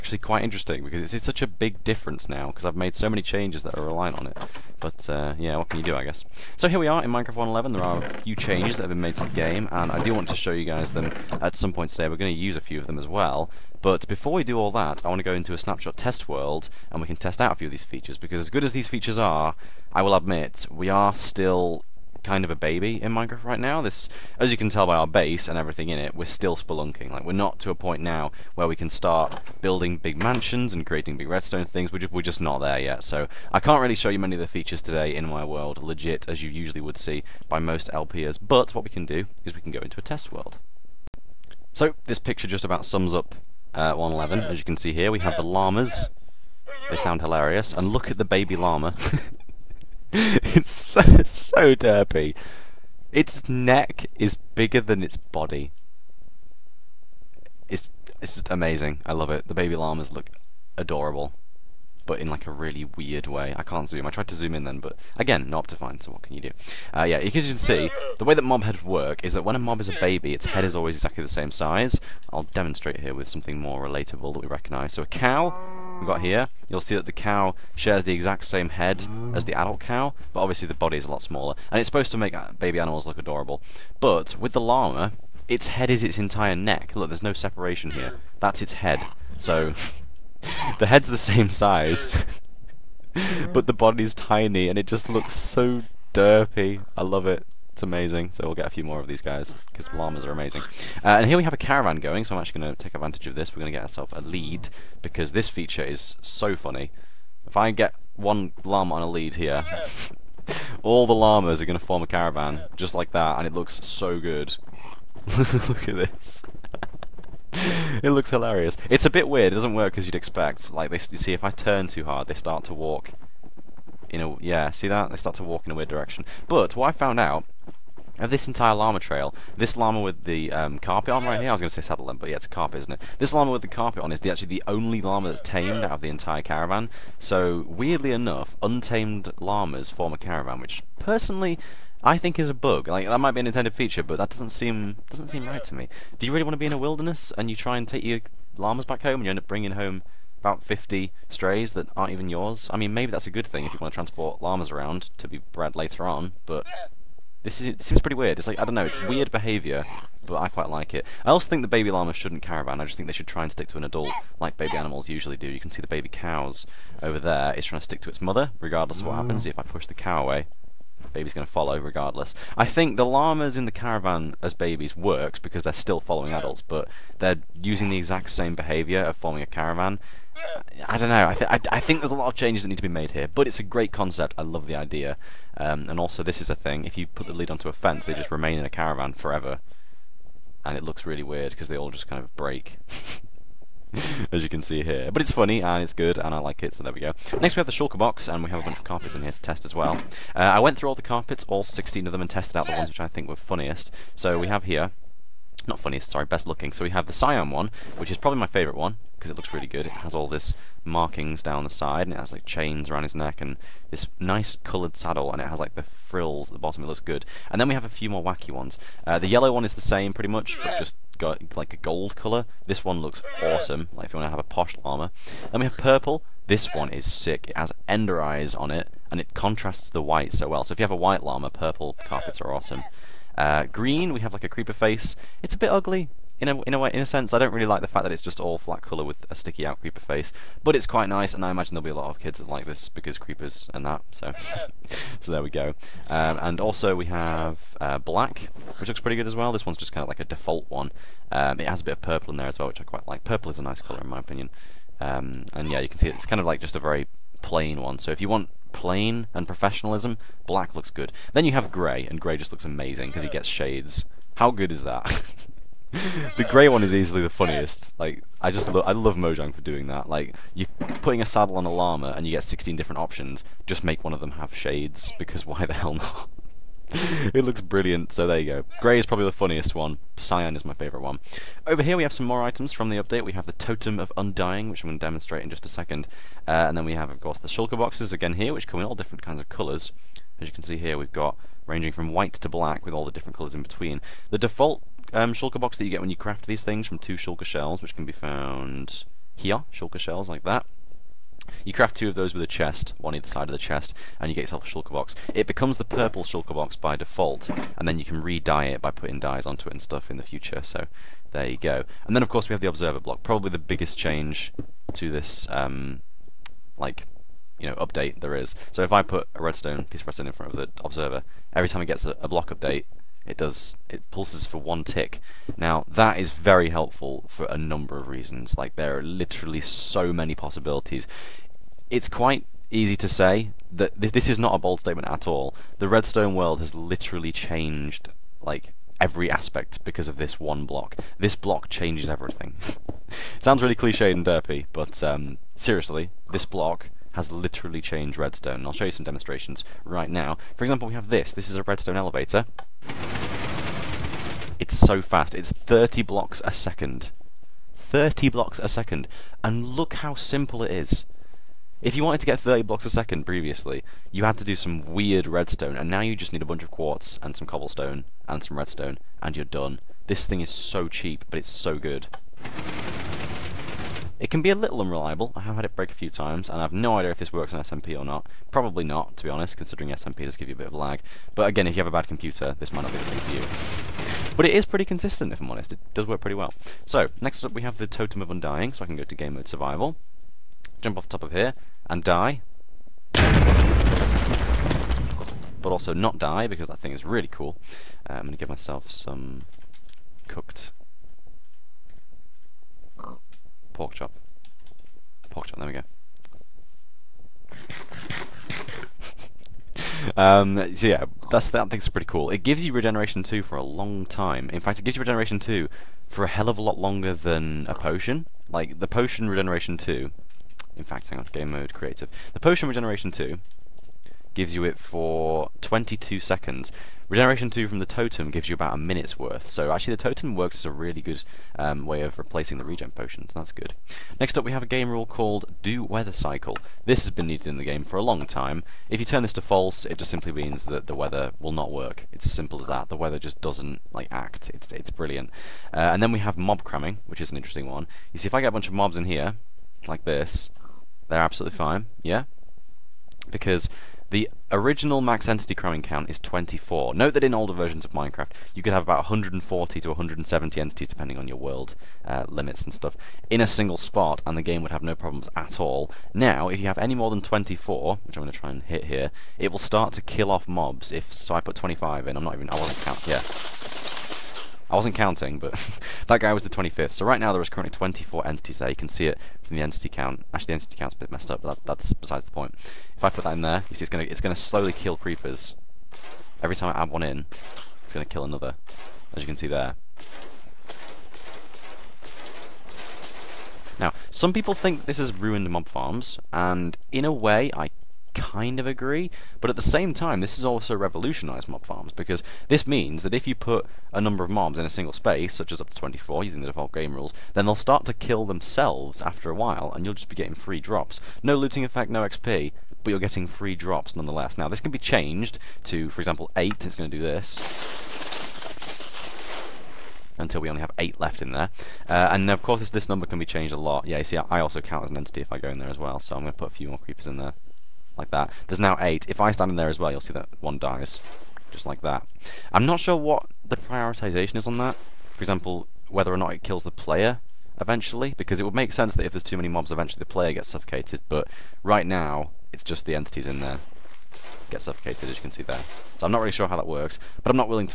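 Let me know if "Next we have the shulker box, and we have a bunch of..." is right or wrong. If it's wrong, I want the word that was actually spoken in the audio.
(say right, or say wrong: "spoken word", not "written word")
right.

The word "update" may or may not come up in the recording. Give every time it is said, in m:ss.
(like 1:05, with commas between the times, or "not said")
4:43, 5:17, 5:22.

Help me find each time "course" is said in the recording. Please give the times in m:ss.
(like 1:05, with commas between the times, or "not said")
4:47, 5:12, 8:42.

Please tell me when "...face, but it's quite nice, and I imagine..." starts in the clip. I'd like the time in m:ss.
3:59.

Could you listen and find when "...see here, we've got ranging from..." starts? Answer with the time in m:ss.
4:50.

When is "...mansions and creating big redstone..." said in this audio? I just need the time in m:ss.
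0:30.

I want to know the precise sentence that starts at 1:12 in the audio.
I'll demonstrate here with something more relatable that we recognise.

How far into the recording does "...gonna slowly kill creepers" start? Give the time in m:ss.
8:04.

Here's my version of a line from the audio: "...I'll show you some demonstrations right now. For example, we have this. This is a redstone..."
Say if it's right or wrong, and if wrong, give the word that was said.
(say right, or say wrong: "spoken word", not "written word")
right.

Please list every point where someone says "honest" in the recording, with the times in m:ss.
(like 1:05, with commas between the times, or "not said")
6:19, 6:25.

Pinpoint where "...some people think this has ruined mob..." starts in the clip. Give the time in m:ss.
8:14.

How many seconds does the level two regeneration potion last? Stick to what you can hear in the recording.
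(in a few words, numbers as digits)
22 seconds.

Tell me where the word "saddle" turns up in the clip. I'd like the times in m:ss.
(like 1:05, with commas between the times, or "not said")
2:11, 3:34, 4:31.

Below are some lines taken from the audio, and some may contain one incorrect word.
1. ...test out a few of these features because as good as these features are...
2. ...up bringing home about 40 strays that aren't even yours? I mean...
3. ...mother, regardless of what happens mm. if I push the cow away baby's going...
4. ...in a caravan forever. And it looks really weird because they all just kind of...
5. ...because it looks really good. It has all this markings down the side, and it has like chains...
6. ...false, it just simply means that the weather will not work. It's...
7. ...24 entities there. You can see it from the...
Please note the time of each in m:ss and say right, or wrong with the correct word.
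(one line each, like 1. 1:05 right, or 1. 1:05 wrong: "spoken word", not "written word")
1. 0:17 right
2. 2:29 wrong: "50", not "40"
3. 2:48 right
4. 3:08 right
5. 3:29 right
6. 7:19 right
7. 7:57 right.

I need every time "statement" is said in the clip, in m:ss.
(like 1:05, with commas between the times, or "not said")
5:34.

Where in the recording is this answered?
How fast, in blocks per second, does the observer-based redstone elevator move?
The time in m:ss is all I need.
5:55.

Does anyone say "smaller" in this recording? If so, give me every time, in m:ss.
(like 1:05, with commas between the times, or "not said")
1:21.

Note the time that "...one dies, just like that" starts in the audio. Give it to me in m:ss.
8:50.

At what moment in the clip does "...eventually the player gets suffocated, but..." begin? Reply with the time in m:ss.
8:59.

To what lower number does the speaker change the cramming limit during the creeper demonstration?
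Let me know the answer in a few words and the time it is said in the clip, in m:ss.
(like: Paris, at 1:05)
8, at 8:34.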